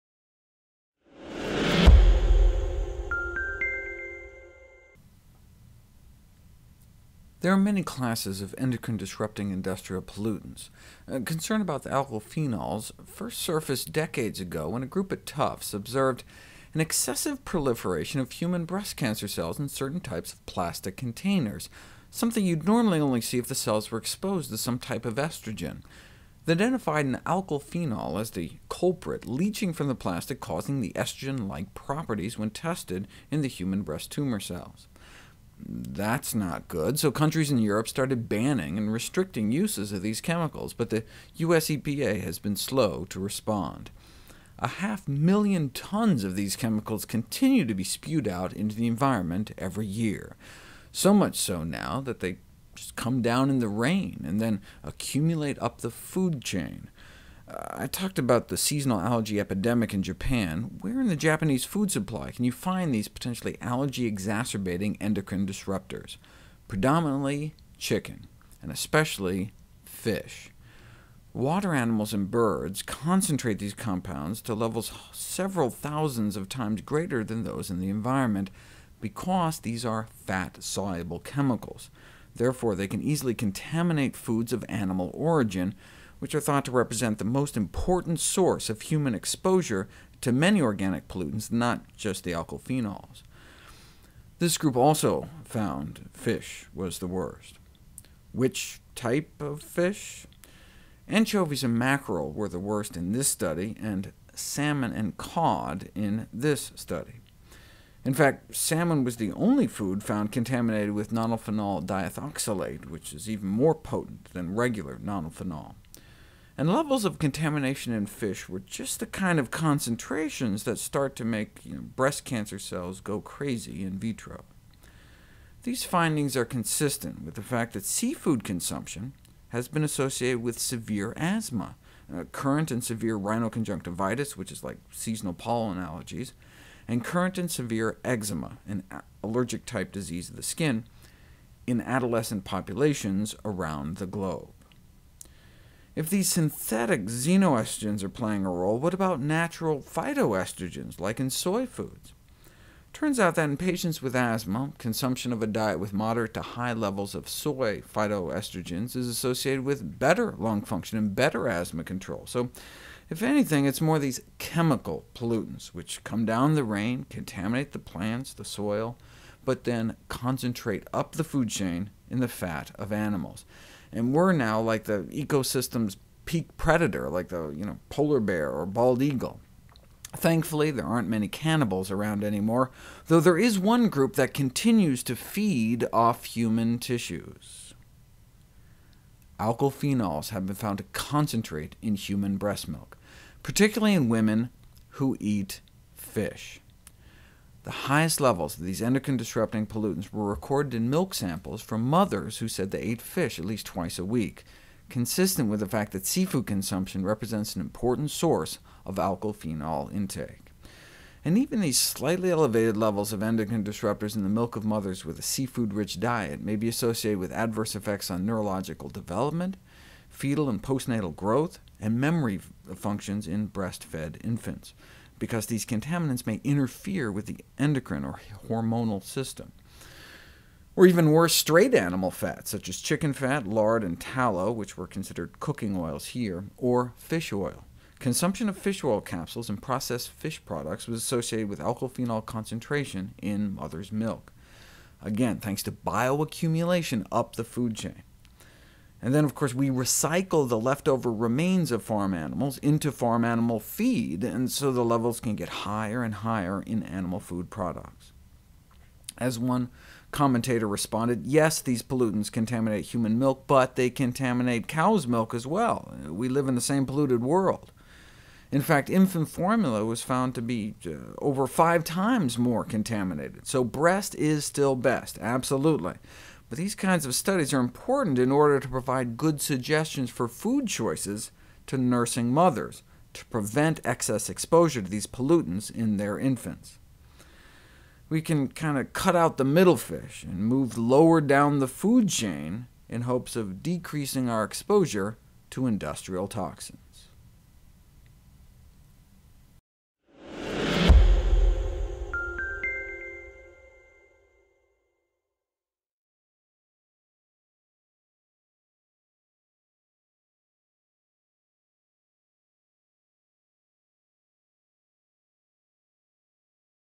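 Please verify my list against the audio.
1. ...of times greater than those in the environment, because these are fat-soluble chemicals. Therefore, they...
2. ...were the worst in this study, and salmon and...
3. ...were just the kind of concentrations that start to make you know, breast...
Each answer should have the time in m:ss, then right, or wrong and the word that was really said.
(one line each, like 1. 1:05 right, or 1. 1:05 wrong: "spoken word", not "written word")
1. 1:16 right
2. 1:42 right
3. 1:58 right.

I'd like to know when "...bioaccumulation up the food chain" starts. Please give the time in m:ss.
4:05.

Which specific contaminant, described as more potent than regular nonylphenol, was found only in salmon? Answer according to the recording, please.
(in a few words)
Nonylphenol diethoxylate.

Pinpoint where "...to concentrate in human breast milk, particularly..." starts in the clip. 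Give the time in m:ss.
3:10.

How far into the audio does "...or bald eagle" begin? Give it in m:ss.
2:58.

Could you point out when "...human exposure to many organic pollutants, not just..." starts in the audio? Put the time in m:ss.
1:28.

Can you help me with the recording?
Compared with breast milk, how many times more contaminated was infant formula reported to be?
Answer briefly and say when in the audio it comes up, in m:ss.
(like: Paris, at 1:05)
Over 5 times, at 4:31.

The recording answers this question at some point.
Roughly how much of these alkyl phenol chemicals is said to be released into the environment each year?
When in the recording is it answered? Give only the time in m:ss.
0:44.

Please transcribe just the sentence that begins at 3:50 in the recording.
Or even worse, straight animal fats, such as chicken fat, lard, and tallow, which were considered cooking oils here, or fish oil.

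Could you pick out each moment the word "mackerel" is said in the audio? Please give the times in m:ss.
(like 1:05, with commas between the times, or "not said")
1:41.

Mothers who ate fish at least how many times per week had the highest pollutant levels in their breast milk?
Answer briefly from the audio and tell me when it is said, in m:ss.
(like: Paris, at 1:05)
Twice a week, at 3:23.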